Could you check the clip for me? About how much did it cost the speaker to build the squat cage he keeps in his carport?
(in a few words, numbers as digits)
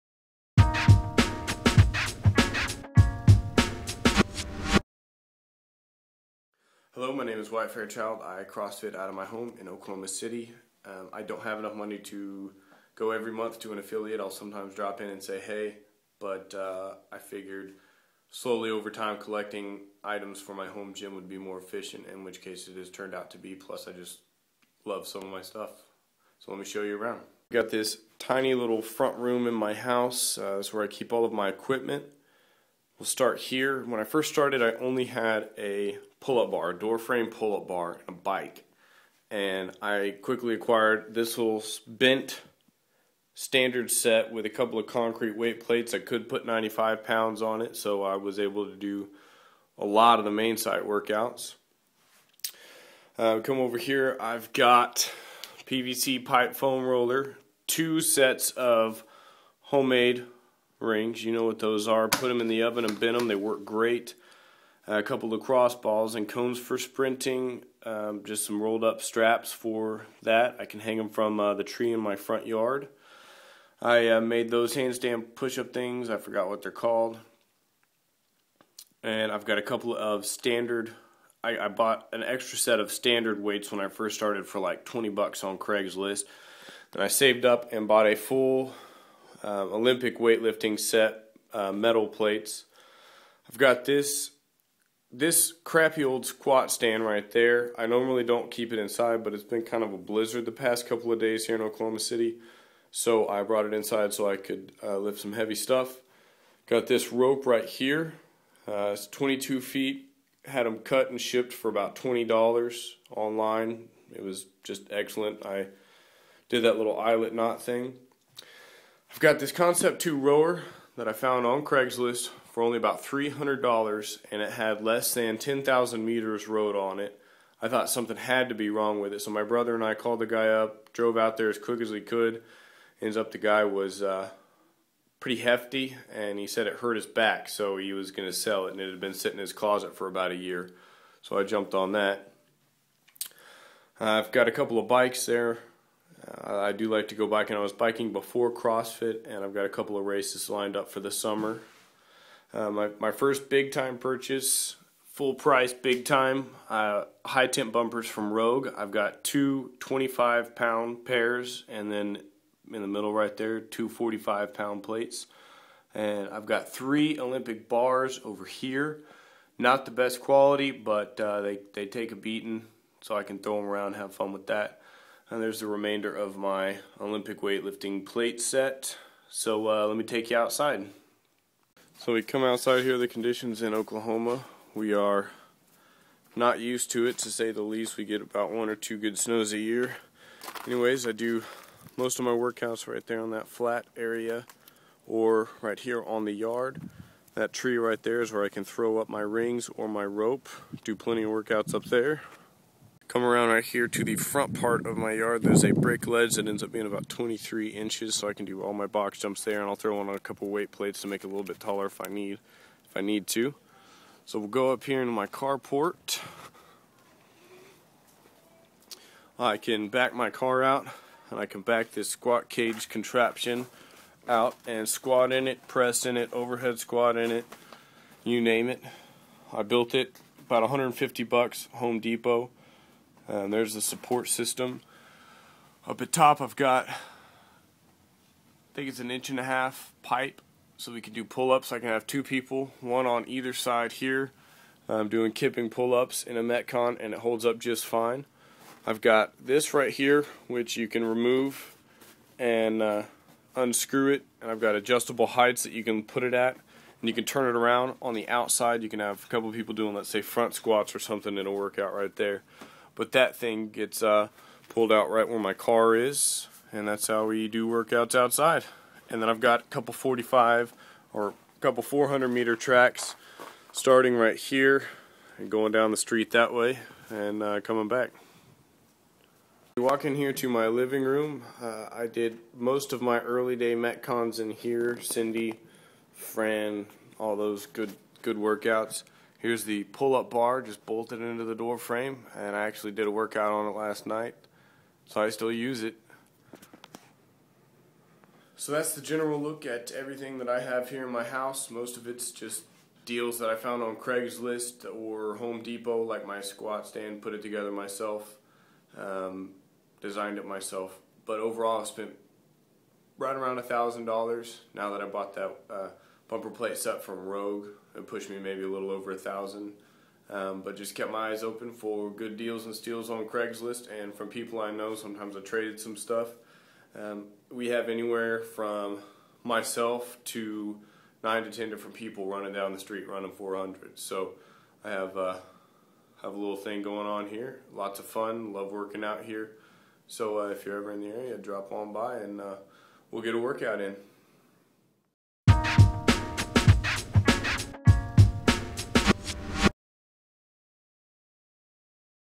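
$150.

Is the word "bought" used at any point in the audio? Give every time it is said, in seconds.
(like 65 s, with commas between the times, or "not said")
81 s, 87 s, 315 s.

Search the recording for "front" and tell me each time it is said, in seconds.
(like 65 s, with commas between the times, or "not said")
28 s, 72 s, 204 s, 260 s.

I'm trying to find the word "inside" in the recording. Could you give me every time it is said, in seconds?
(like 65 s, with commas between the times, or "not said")
98 s, 103 s.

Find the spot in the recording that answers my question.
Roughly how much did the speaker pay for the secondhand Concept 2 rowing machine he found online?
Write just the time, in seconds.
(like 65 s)
123 s.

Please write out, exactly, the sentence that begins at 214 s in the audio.
So we'll go up here into my carport.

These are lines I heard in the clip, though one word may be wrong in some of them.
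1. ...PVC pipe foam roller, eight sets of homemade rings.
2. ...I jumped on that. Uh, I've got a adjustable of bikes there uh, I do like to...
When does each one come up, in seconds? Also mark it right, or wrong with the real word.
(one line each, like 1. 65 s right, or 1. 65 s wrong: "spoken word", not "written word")
1. 55 s wrong: "two", not "eight"
2. 141 s wrong: "couple", not "adjustable".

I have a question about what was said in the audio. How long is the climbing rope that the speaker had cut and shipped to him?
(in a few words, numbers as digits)
22 feet.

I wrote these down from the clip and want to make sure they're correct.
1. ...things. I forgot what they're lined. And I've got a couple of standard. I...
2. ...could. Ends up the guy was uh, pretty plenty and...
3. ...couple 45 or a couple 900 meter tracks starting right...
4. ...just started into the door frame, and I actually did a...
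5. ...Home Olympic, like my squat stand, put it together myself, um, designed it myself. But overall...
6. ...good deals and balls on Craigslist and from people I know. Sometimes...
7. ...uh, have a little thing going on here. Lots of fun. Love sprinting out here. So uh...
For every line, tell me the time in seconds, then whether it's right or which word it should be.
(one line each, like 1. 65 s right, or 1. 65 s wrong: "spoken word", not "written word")
1. 75 s wrong: "called", not "lined"
2. 132 s wrong: "hefty", not "plenty"
3. 269 s wrong: "400", not "900"
4. 290 s wrong: "bolted", not "started"
5. 305 s wrong: "Depot", not "Olympic"
6. 322 s wrong: "steals", not "balls"
7. 335 s wrong: "working", not "sprinting".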